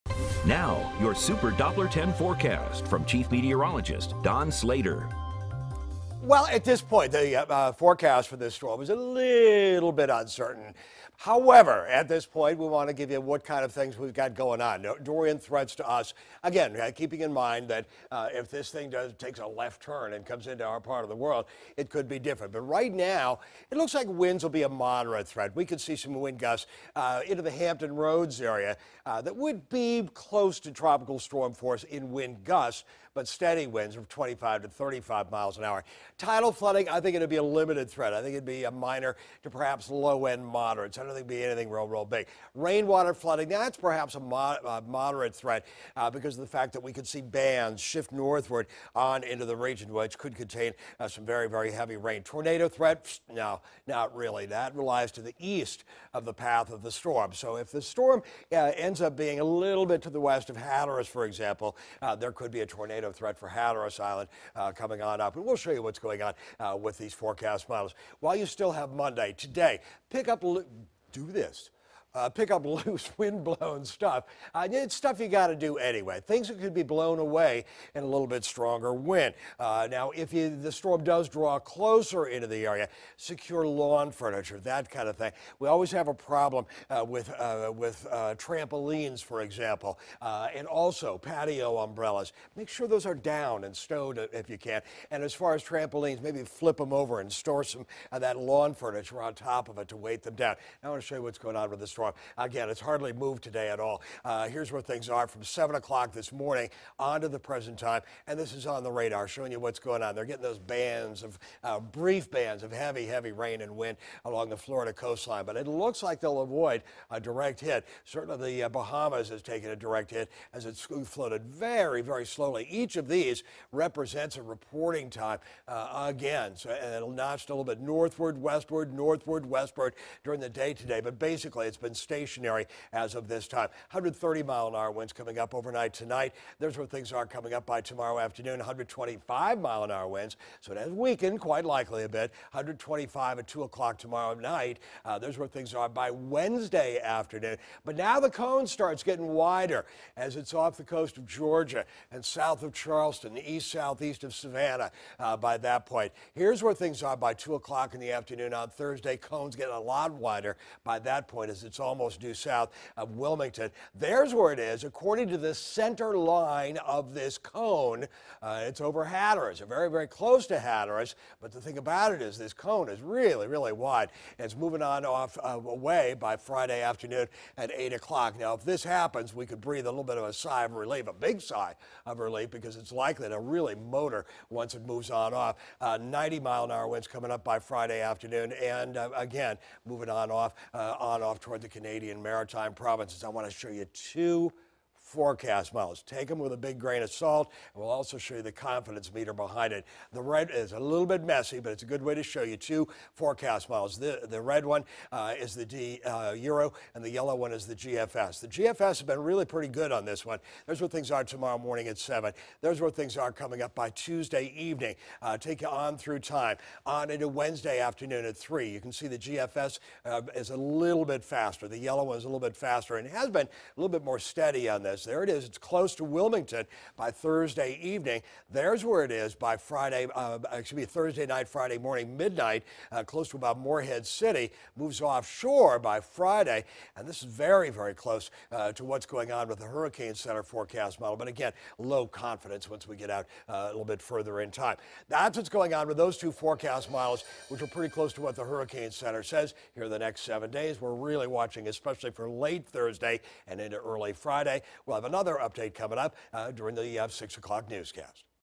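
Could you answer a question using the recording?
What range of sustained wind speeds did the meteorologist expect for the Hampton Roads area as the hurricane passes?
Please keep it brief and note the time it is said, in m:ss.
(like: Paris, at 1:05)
25 to 35 miles an hour, at 0:34.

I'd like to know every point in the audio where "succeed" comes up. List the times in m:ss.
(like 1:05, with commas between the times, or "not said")
not said.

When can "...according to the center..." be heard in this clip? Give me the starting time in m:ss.
2:44.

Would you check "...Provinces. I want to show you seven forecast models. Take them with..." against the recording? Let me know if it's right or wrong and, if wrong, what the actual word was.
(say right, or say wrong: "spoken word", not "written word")
wrong: "two", not "seven".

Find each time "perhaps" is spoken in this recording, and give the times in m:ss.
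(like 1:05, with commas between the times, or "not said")
0:39, 0:43.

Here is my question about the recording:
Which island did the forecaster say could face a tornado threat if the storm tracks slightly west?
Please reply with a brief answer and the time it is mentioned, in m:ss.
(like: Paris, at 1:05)
Hatteras Island, at 1:03.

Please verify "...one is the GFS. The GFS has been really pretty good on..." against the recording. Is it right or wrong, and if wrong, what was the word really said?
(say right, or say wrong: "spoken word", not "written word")
right.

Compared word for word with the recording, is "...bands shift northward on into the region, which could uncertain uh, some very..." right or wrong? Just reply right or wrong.
wrong.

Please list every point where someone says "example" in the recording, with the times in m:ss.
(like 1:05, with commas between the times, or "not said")
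1:01, 1:29.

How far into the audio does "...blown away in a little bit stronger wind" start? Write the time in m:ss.
1:16.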